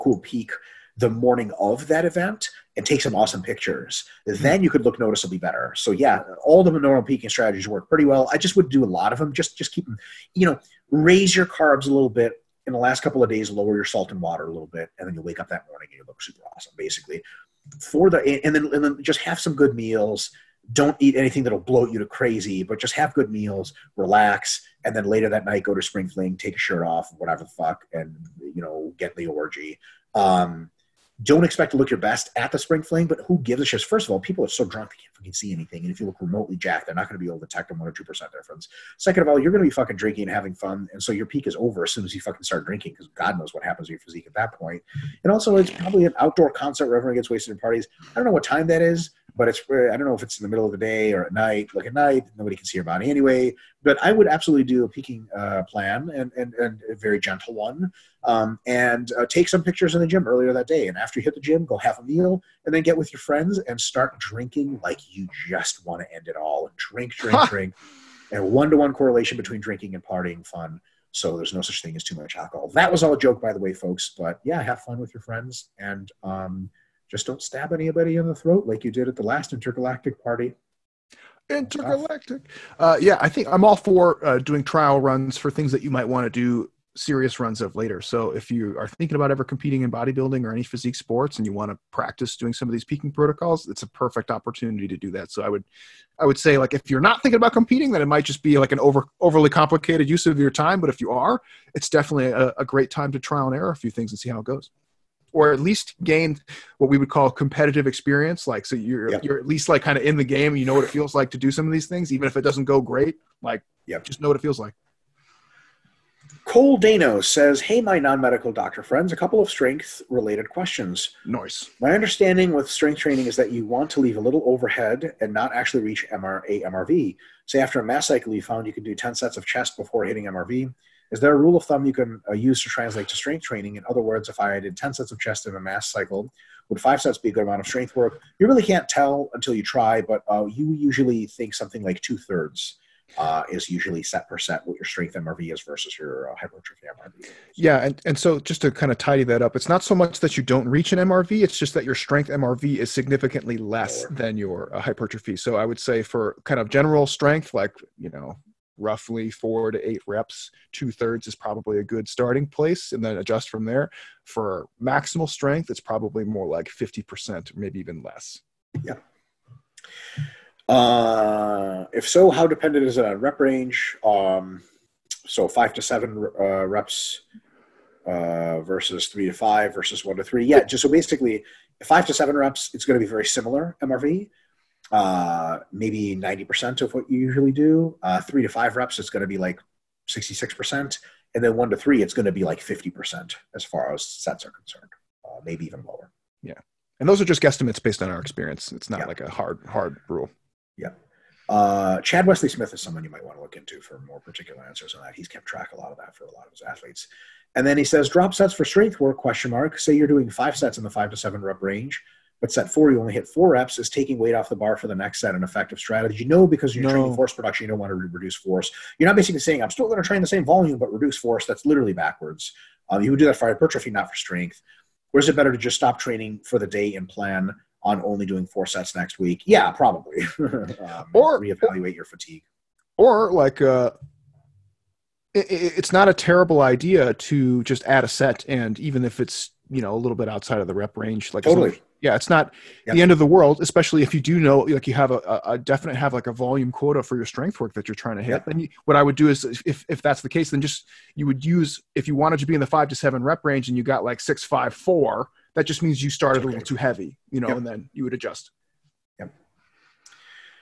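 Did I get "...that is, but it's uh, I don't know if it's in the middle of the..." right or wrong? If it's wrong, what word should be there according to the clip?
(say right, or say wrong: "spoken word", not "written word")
right.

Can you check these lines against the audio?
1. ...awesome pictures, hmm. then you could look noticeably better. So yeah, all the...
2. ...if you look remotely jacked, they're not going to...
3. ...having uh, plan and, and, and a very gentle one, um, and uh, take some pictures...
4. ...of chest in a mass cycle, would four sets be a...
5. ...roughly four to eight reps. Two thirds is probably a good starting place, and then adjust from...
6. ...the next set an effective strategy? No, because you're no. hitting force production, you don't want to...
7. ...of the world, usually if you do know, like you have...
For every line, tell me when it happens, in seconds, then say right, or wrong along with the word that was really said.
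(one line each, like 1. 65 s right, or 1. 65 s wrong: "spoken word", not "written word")
1. 3 s right
2. 35 s right
3. 54 s wrong: "peaking", not "having"
4. 135 s wrong: "five", not "four"
5. 158 s right
6. 214 s wrong: "training", not "hitting"
7. 243 s wrong: "especially", not "usually".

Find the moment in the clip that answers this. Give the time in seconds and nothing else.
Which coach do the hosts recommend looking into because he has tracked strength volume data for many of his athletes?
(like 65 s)
202 s.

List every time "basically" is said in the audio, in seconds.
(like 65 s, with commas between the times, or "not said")
16 s, 180 s, 219 s.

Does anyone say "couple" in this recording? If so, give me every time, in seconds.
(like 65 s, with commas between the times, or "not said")
13 s, 119 s.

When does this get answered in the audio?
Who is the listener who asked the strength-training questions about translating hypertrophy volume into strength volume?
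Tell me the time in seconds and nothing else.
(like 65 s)
116 s.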